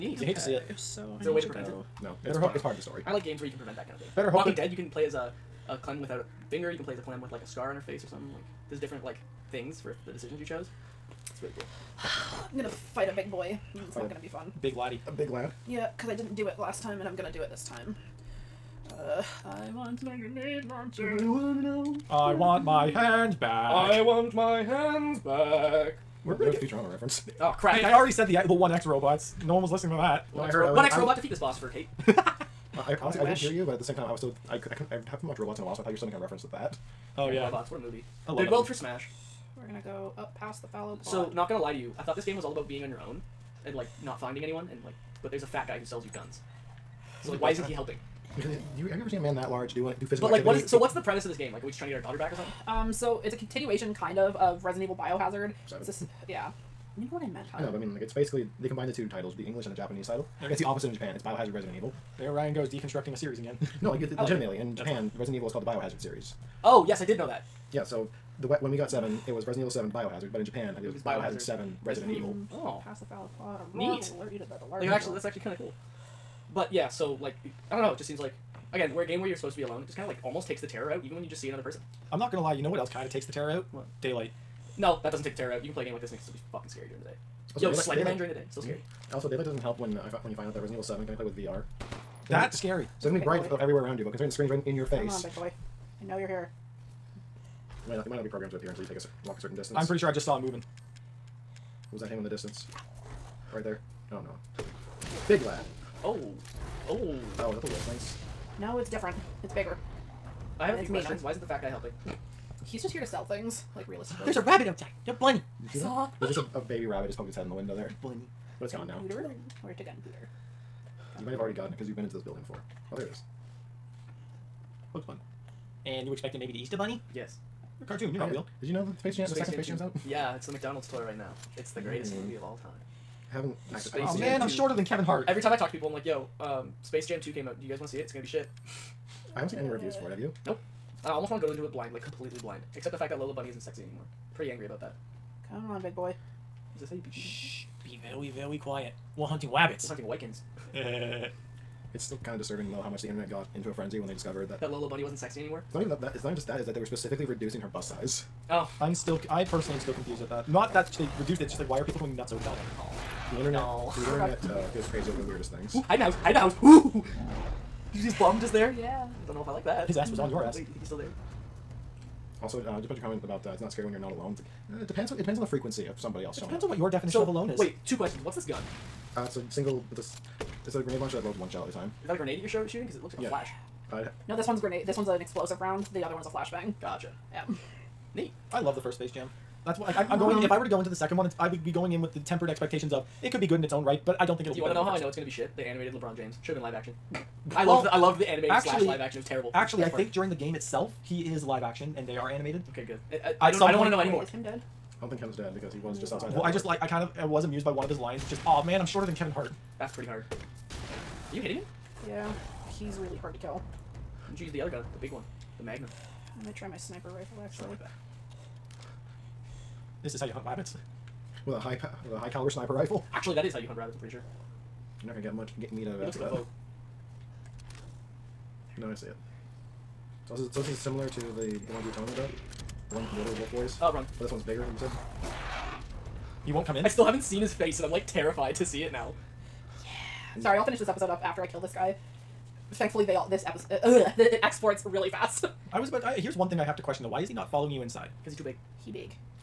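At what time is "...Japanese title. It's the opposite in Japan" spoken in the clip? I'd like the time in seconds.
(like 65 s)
59 s.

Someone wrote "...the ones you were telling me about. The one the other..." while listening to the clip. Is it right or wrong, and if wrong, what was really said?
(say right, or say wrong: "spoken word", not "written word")
right.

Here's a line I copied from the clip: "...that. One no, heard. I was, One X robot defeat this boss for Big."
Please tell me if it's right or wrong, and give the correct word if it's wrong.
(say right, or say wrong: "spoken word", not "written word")
wrong: "Kate", not "Big".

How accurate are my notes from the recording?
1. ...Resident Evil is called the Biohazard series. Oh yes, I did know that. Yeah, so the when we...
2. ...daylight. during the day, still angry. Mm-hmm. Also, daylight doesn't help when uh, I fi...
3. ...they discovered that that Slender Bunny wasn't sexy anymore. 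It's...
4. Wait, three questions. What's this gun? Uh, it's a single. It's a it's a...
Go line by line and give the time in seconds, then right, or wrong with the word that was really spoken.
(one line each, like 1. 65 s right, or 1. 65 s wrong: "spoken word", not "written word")
1. 65 s right
2. 87 s wrong: "scary", not "angry"
3. 154 s wrong: "Lola", not "Slender"
4. 177 s wrong: "two", not "three".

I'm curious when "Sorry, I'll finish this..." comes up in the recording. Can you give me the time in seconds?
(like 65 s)
240 s.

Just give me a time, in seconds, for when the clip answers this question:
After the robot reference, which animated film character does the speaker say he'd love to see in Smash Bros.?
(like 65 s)
38 s.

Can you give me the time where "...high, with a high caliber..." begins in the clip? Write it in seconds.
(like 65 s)
221 s.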